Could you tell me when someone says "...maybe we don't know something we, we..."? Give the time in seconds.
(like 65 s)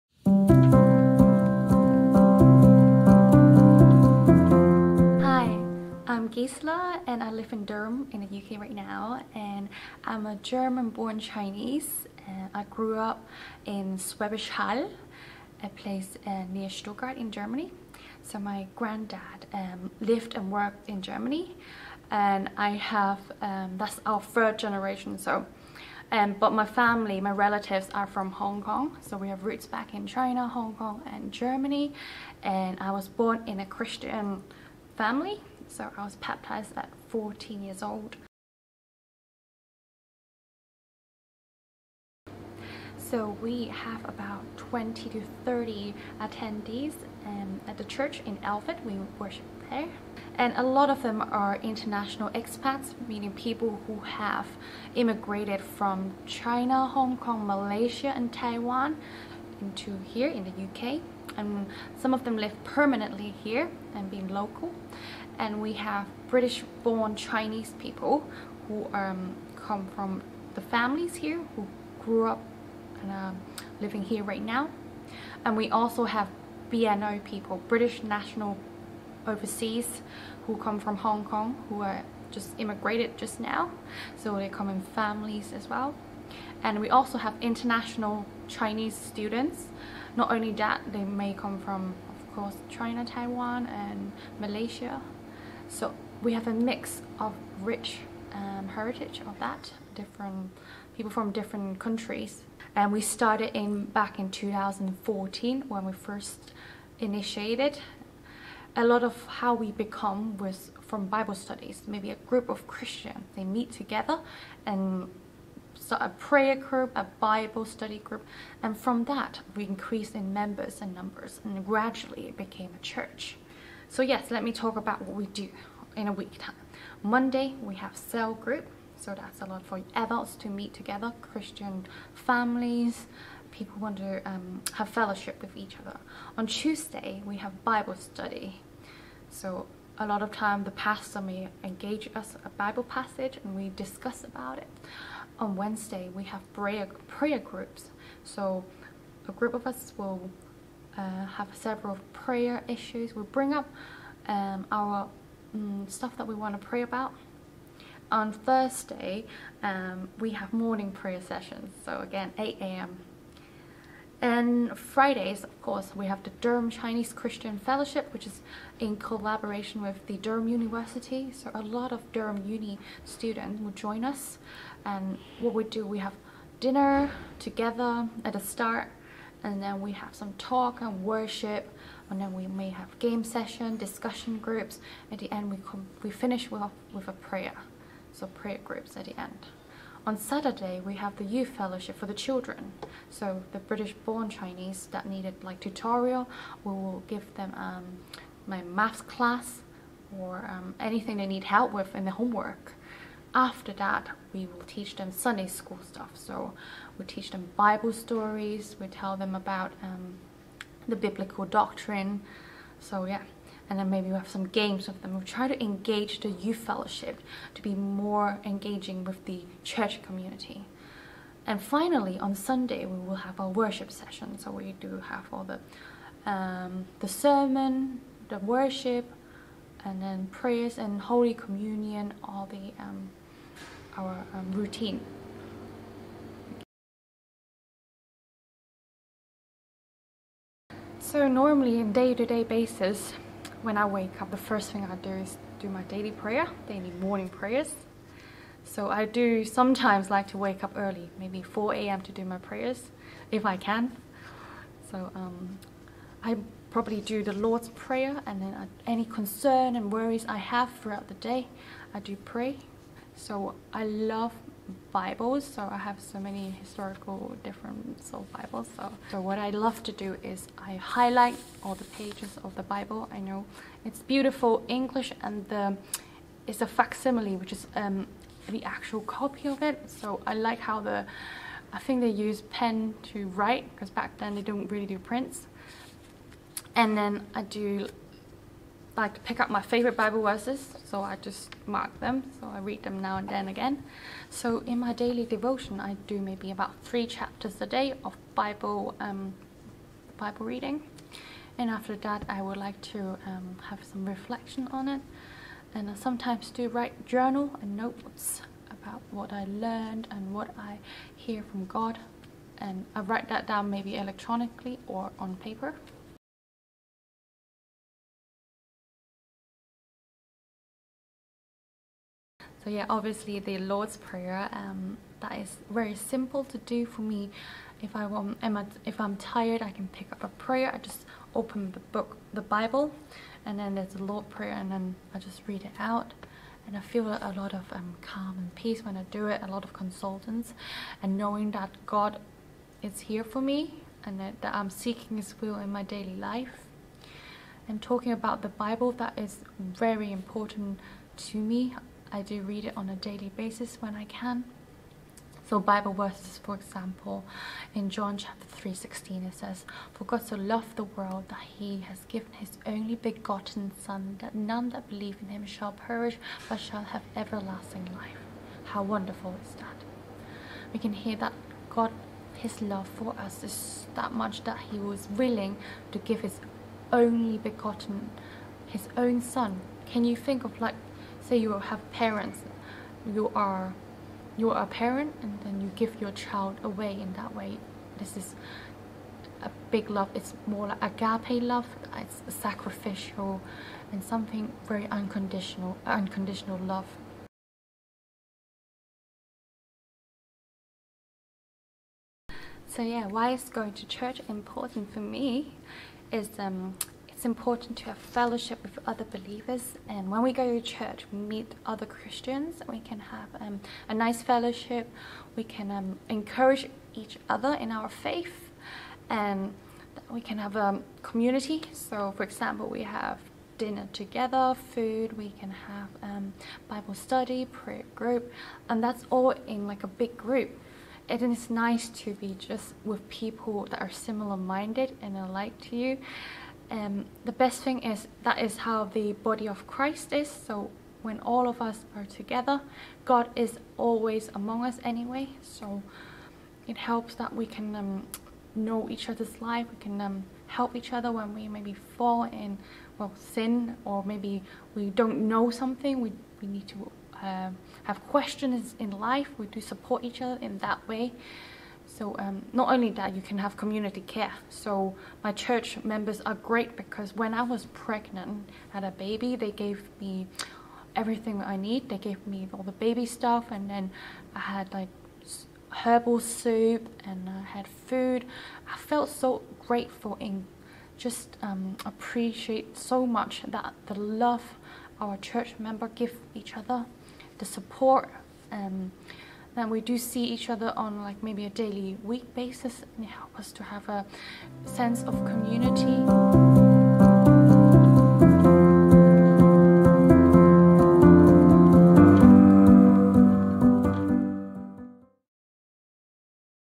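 454 s.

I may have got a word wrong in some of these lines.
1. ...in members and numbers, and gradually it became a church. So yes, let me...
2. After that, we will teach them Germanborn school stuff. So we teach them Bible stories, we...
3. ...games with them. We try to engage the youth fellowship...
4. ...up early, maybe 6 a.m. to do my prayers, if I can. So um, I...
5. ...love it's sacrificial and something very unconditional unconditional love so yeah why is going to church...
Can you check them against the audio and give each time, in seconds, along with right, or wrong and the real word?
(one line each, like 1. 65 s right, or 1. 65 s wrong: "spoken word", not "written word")
1. 120 s right
2. 203 s wrong: "Sunday", not "Germanborn"
3. 214 s right
4. 250 s wrong: "4", not "6"
5. 391 s right.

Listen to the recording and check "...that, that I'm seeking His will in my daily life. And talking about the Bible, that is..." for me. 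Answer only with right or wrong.
right.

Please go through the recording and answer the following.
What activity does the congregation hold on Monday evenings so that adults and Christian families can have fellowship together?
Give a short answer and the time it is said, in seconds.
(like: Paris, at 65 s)
Cell group, at 127 s.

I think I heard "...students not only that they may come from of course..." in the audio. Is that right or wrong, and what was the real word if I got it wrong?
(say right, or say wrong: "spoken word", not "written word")
right.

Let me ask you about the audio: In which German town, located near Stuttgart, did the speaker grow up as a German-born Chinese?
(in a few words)
Schwäbisch Hall.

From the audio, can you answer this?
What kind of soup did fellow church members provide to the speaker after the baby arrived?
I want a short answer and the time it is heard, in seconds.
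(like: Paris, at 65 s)
Herbal soup, at 475 s.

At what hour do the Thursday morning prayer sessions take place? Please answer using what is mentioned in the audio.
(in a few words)
8 a.m.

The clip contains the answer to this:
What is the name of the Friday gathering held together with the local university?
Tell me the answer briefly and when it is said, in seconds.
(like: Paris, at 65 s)
Durham Chinese Christian Fellowship, at 166 s.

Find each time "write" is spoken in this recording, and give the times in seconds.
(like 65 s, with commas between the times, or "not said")
283 s, 306 s, 312 s.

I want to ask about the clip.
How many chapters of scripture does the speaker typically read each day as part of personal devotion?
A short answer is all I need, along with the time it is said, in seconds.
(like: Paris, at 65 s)
3, at 296 s.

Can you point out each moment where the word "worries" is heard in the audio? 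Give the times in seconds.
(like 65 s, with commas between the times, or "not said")
259 s.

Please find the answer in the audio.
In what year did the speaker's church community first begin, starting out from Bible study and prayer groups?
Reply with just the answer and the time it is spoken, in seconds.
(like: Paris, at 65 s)
2014, at 104 s.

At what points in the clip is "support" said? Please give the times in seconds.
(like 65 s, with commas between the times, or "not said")
459 s, 487 s.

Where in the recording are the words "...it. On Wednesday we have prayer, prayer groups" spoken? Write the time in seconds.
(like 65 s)
144 s.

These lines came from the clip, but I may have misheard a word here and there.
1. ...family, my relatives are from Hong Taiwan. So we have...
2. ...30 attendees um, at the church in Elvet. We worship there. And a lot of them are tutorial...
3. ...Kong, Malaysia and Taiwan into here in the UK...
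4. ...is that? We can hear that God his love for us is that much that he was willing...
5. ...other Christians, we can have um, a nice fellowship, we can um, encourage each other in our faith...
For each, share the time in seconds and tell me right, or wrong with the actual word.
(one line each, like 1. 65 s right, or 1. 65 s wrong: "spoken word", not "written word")
1. 26 s wrong: "Kong", not "Taiwan"
2. 45 s wrong: "international", not "tutorial"
3. 57 s right
4. 369 s right
5. 411 s right.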